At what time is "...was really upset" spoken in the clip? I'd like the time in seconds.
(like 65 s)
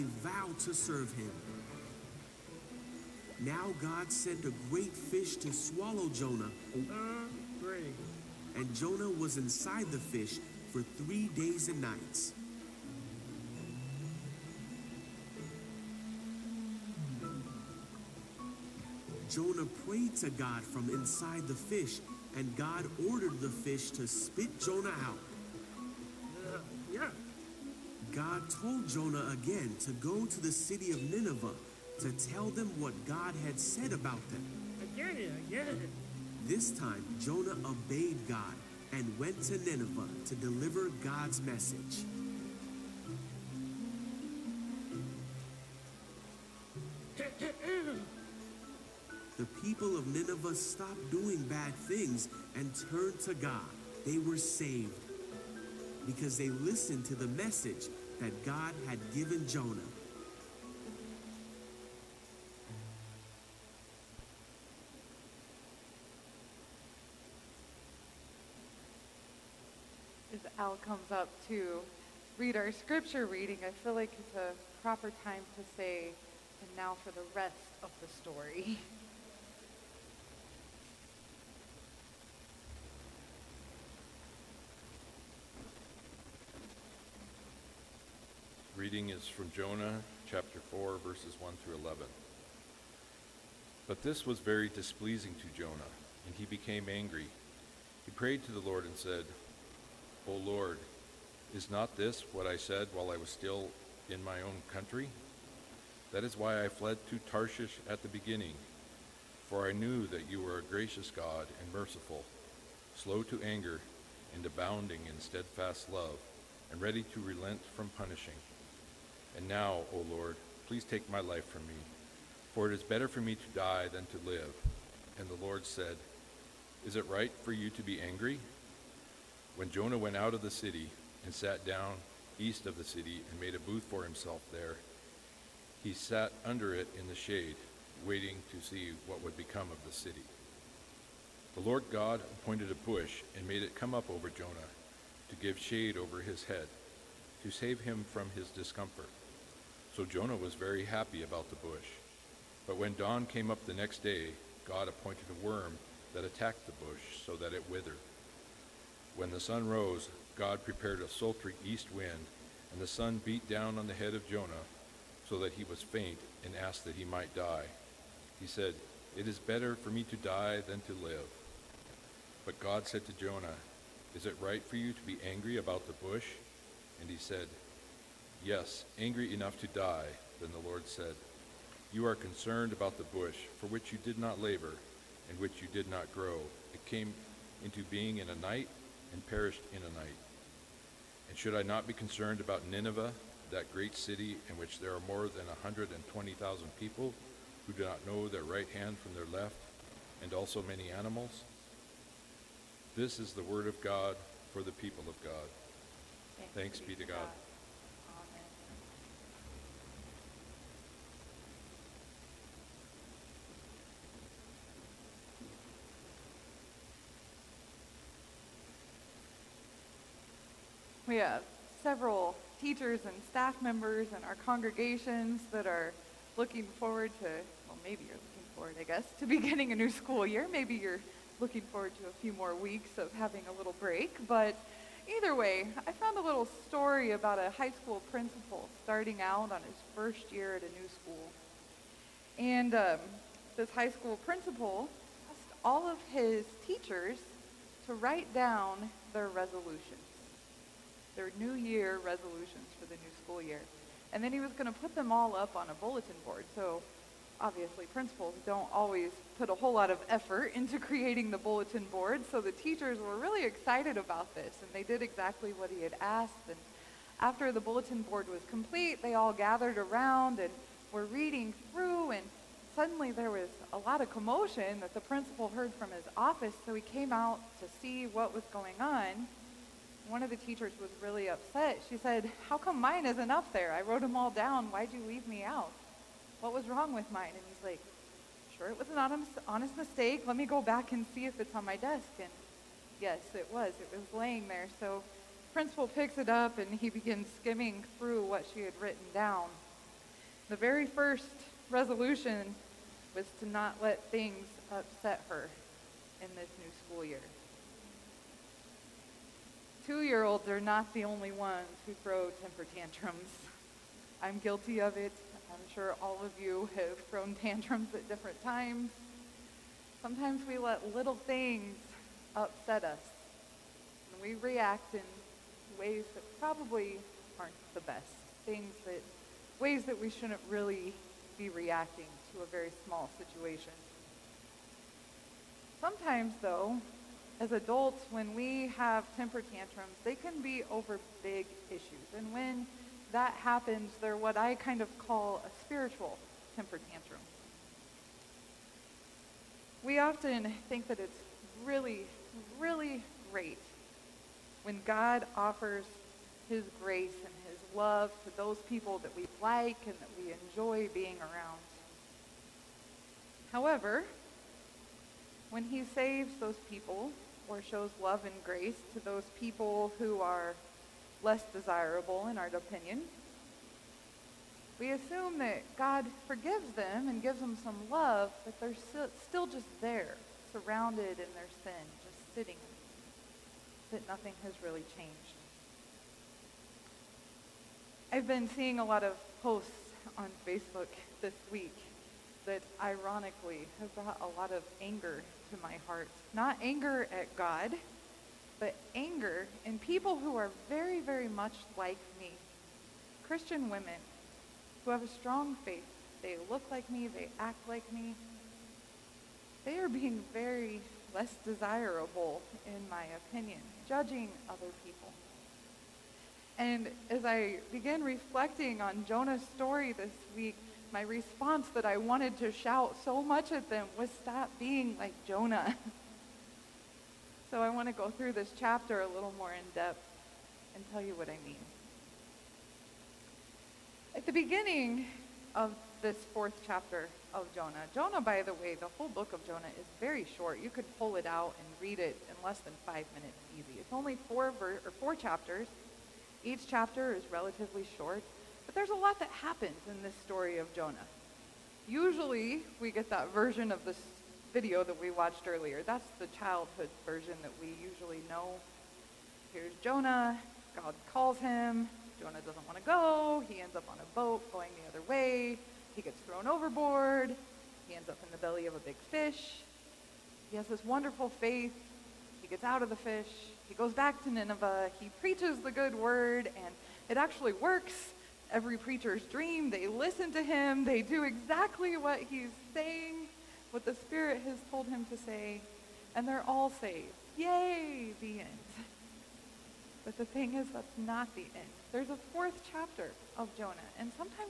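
280 s.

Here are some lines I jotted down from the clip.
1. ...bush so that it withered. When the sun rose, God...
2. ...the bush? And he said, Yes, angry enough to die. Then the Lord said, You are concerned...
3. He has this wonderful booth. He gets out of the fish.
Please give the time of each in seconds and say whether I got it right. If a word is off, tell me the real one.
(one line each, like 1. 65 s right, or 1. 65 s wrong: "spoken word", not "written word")
1. 156 s right
2. 175 s right
3. 470 s wrong: "faith", not "booth".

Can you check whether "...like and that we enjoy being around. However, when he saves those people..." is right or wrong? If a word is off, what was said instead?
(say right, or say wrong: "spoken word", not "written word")
right.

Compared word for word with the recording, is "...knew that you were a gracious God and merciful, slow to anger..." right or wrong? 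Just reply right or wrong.
right.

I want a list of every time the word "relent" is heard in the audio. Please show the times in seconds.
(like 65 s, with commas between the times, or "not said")
117 s.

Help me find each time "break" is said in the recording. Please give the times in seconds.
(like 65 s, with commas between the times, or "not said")
233 s.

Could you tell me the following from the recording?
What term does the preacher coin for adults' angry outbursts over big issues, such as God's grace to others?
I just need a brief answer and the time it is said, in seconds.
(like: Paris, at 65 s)
Spiritual temper tantrum, at 345 s.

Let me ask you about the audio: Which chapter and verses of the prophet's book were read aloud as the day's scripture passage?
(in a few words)
Jonah 4:1-11.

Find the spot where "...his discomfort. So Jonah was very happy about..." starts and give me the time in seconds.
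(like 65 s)
148 s.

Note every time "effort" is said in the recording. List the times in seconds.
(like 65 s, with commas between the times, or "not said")
260 s.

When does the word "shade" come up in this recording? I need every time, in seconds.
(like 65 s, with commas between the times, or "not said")
137 s, 145 s.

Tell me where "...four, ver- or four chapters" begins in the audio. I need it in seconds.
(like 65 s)
444 s.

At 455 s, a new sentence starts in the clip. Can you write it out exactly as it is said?
That's the childhood version that we usually know.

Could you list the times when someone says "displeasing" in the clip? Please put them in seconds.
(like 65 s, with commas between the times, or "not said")
94 s.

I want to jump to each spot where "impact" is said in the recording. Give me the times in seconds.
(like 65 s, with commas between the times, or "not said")
not said.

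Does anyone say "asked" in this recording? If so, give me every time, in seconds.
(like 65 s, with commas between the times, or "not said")
166 s, 245 s, 266 s.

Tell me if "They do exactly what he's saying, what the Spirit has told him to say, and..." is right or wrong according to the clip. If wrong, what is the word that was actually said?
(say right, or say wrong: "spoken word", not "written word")
right.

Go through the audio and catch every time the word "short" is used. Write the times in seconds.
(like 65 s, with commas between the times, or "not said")
440 s, 447 s.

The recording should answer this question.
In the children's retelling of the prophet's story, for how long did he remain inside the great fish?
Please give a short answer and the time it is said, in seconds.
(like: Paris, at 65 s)
3 days and nights, at 10 s.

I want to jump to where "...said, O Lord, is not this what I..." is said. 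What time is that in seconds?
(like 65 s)
98 s.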